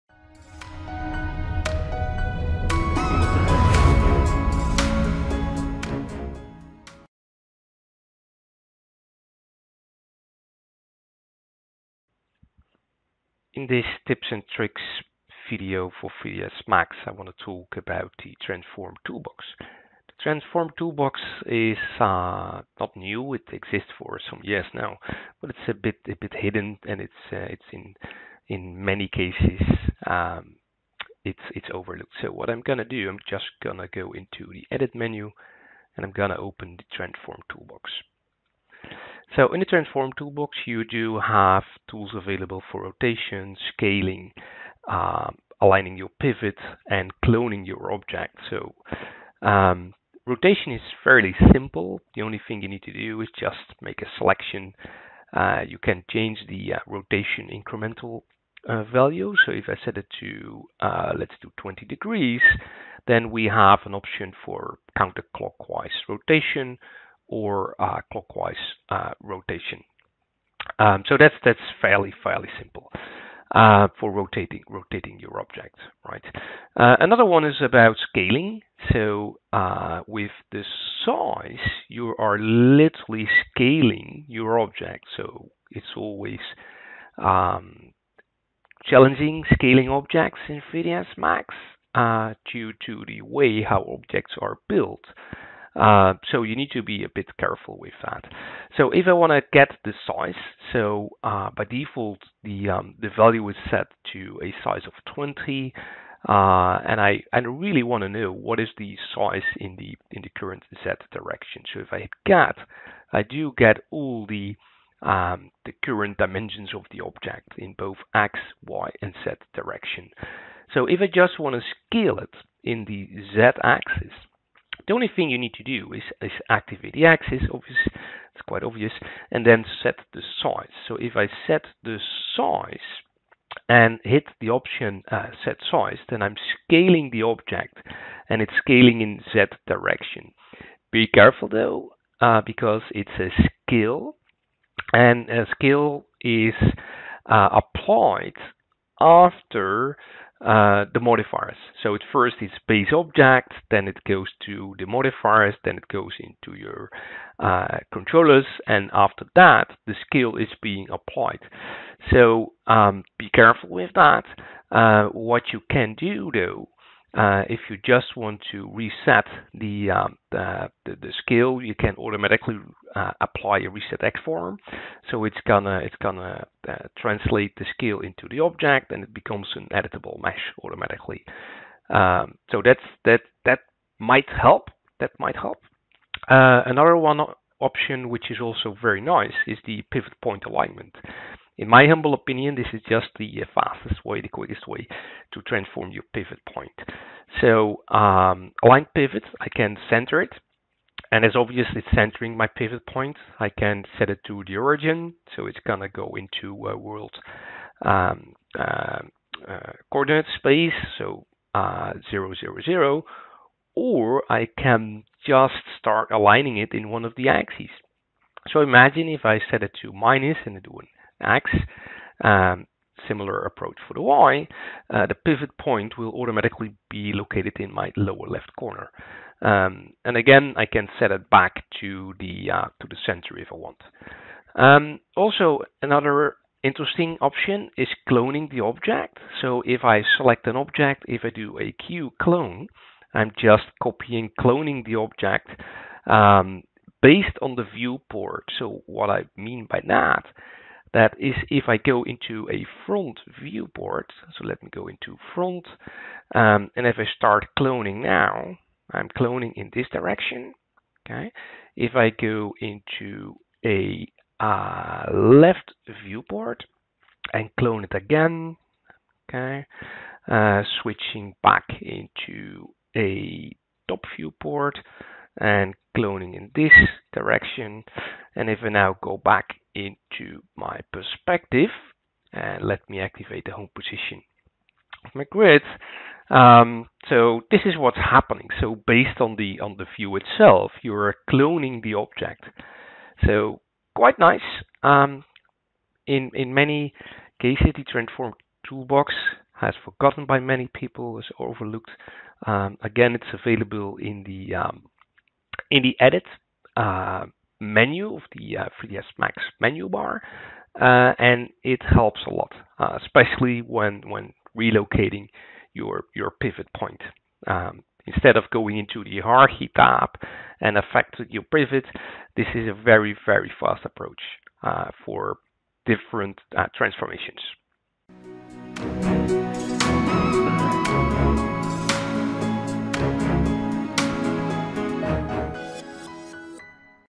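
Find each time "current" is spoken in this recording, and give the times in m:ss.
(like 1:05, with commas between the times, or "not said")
1:50, 1:55.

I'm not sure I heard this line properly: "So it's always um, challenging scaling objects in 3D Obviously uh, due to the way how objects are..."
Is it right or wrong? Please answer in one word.
wrong.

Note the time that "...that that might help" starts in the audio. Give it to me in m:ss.
3:03.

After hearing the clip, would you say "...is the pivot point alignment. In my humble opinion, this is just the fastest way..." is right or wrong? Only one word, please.
right.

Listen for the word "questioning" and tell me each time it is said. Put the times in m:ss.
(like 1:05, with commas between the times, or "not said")
not said.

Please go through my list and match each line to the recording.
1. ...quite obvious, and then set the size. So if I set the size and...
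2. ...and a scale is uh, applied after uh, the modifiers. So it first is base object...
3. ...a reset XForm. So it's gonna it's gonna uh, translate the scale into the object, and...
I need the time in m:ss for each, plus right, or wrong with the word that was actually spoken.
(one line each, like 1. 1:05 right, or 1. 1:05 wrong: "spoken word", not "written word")
1. 2:08 right
2. 2:24 right
3. 2:53 right.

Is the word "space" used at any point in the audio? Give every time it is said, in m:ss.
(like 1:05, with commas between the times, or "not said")
3:30.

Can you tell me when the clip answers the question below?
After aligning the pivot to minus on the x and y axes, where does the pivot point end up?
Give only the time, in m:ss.
3:47.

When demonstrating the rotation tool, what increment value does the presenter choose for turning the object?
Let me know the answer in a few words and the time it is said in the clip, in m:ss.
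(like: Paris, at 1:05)
20 degrees, at 1:01.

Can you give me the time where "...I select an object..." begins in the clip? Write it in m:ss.
3:59.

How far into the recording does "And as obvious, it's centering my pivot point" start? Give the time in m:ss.
3:21.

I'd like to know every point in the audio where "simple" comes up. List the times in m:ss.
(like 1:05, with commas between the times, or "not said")
0:51, 1:12.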